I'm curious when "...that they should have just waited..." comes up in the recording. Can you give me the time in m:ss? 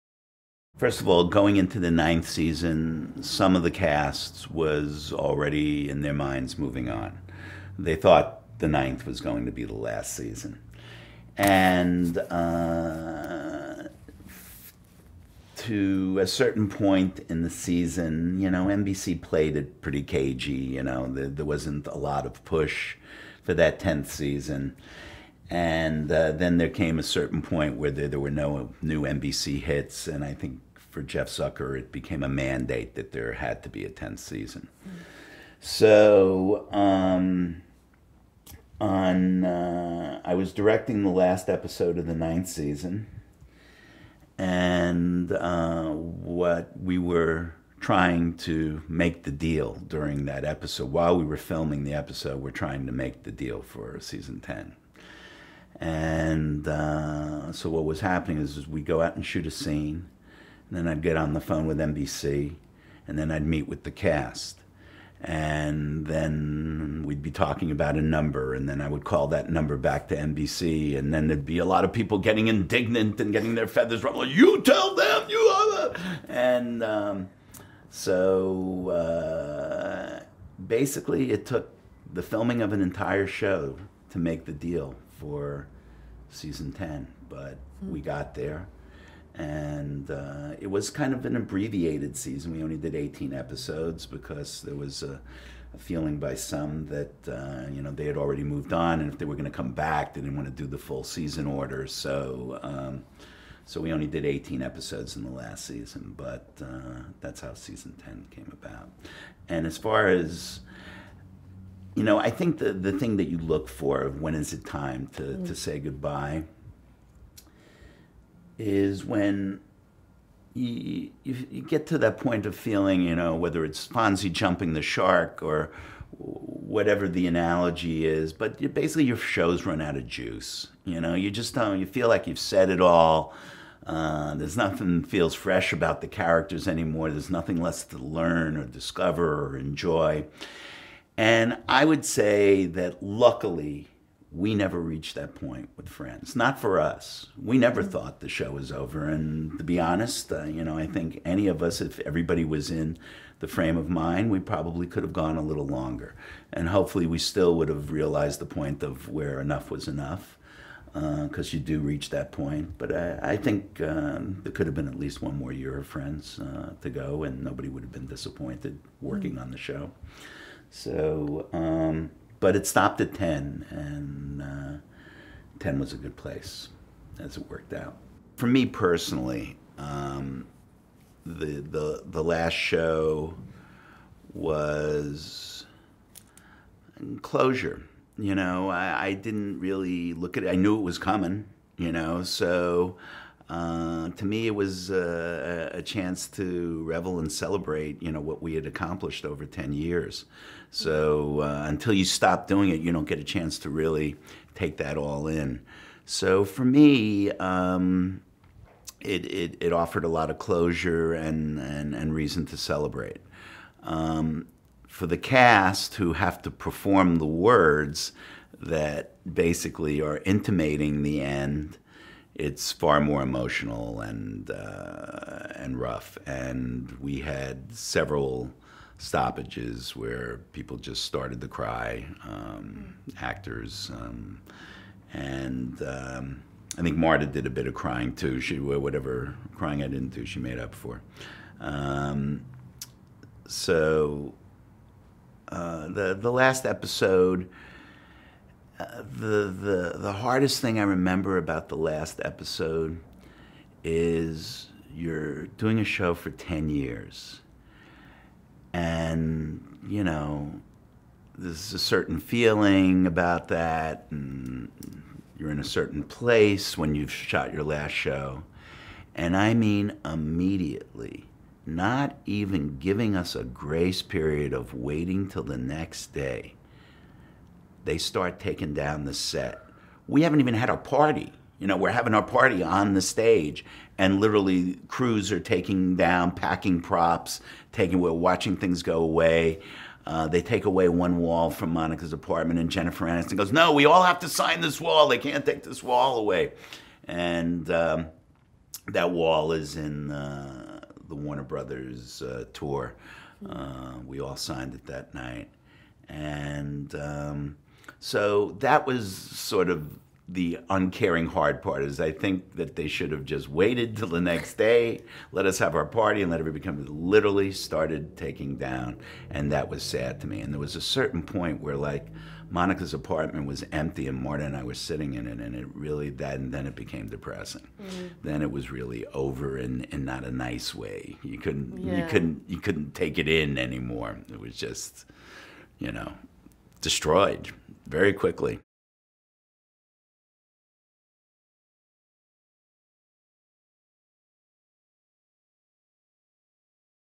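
5:12.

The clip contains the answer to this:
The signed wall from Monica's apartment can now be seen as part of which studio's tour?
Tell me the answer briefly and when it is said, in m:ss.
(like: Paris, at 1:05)
Warner Brothers, at 5:01.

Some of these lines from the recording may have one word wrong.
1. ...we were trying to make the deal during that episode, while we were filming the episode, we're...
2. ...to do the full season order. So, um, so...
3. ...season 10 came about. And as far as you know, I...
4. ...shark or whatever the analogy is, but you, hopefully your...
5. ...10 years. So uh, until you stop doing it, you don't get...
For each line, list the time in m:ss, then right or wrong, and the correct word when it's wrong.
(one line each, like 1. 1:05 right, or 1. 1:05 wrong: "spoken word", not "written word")
1. 0:46 right
2. 1:40 right
3. 1:47 right
4. 2:04 wrong: "basically", not "hopefully"
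5. 3:19 right.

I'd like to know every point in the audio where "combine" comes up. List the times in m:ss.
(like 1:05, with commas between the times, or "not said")
not said.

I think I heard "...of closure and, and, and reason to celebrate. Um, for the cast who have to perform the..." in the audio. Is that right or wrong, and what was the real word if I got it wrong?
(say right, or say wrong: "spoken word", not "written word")
right.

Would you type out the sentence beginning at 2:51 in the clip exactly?
Um, but it stopped at 10, and uh, 10 was a good place as it worked out.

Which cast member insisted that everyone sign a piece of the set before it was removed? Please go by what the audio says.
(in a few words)
Jennifer Aniston.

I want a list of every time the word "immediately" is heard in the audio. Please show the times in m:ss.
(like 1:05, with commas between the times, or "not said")
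4:30.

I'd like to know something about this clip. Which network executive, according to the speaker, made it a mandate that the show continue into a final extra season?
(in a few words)
Jeff Zucker.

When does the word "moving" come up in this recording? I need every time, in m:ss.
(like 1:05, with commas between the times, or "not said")
0:06.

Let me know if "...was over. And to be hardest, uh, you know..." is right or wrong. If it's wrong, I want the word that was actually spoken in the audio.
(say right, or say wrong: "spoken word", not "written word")
wrong: "honest", not "hardest".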